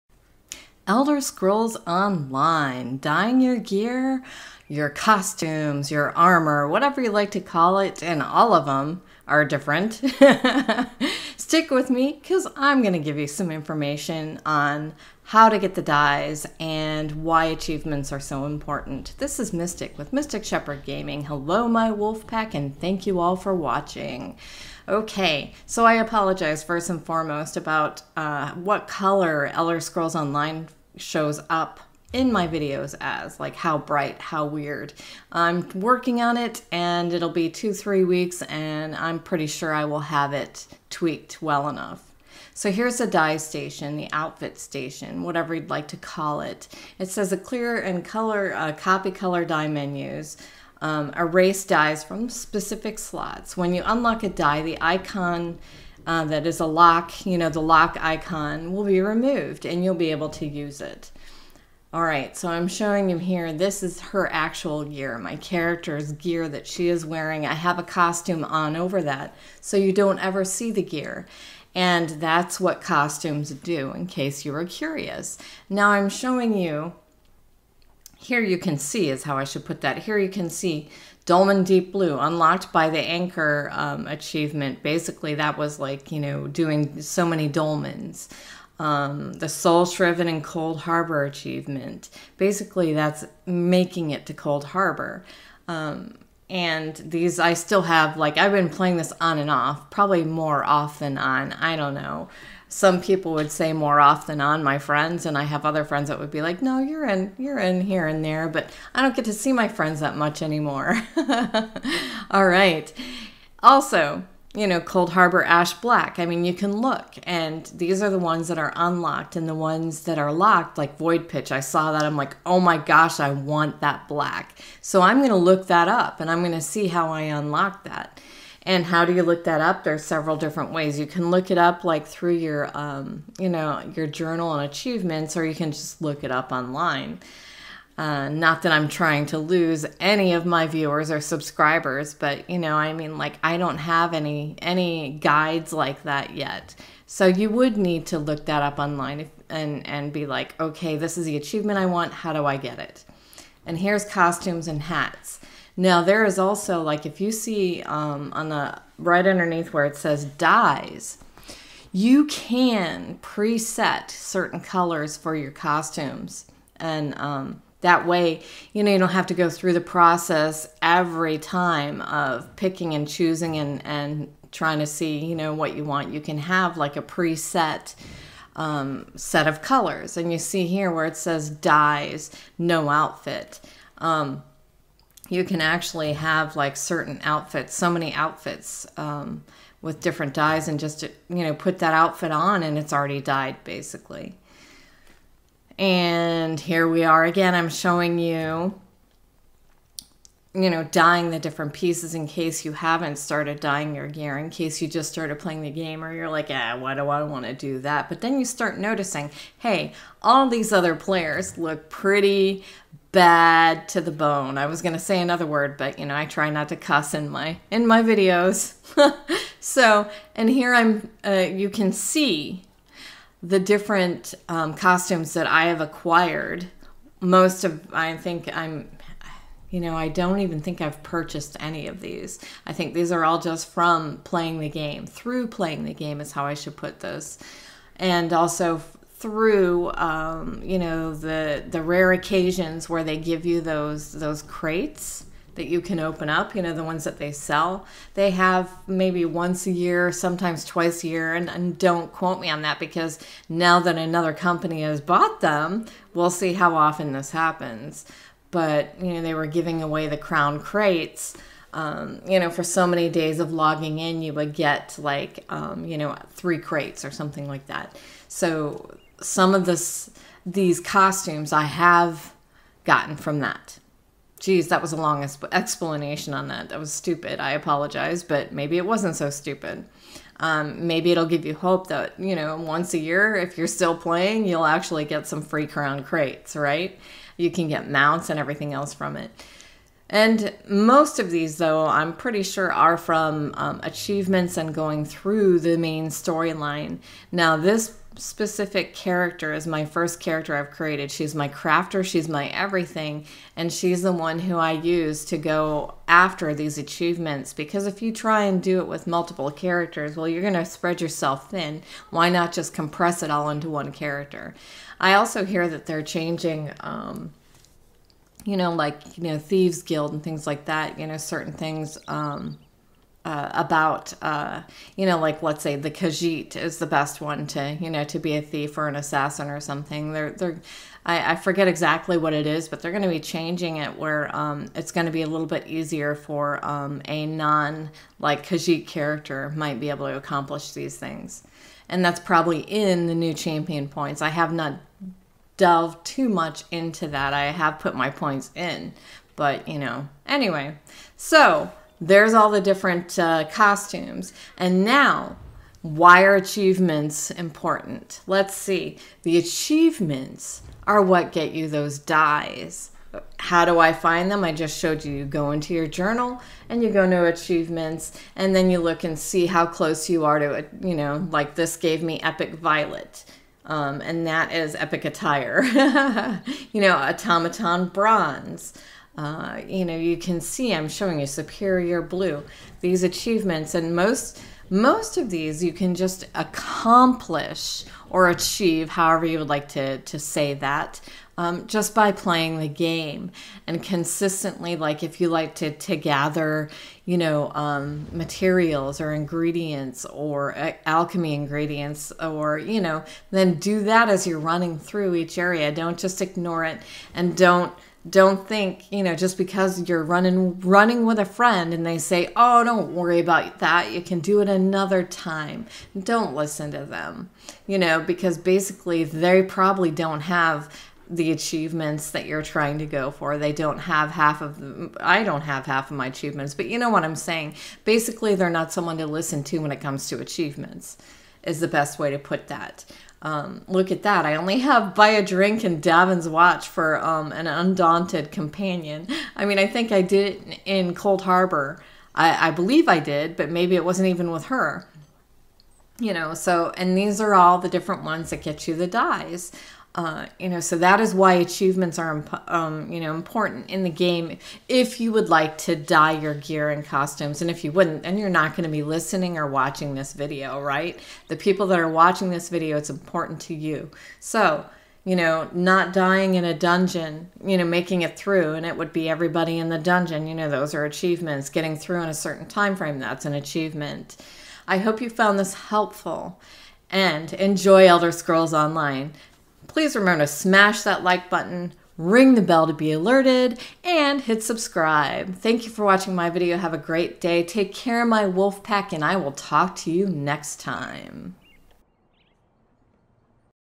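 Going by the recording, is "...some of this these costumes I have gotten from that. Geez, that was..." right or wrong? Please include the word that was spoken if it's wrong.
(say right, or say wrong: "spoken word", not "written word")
right.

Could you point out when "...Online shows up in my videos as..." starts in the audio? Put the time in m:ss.
0:30.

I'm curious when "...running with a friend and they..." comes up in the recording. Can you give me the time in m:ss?
6:50.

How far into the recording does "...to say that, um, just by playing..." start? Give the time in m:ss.
6:29.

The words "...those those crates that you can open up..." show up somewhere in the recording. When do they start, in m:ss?
4:03.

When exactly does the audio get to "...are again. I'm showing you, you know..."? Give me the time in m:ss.
3:17.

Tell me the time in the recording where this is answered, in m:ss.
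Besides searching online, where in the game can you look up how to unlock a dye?
2:14.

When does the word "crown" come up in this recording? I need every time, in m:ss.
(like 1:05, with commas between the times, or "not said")
4:20, 4:45.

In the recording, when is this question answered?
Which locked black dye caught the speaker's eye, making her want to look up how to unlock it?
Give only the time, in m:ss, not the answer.
2:00.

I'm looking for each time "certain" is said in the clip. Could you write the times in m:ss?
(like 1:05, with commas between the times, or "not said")
2:44, 3:06, 5:21, 7:52.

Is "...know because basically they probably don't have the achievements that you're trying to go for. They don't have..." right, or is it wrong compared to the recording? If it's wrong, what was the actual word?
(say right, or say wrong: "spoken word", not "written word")
right.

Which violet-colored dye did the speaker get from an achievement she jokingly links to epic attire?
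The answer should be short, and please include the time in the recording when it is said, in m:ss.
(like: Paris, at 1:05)
Epic Violet, at 6:12.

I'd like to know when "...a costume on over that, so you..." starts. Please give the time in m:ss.
1:07.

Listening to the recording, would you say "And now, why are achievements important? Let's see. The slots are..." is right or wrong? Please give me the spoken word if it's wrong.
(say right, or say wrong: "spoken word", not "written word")
wrong: "achievements", not "slots".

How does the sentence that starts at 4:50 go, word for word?
And most of these, though, I'm pretty sure are from um, achievements and going through the main storyline.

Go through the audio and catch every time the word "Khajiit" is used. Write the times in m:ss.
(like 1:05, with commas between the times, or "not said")
5:25, 5:38.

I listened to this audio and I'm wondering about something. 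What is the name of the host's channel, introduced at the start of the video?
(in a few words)
Mystic Shepherd Gaming.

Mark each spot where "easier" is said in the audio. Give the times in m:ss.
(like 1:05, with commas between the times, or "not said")
5:35.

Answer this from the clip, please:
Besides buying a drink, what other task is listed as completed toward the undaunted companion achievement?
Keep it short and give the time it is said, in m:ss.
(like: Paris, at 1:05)
Davin's Watch, at 7:15.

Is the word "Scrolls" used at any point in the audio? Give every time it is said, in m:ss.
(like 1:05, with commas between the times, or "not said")
0:01, 0:29, 7:58.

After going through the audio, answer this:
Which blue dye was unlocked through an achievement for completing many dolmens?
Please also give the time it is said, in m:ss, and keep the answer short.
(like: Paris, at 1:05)
Dolmen Deep Blue, at 1:21.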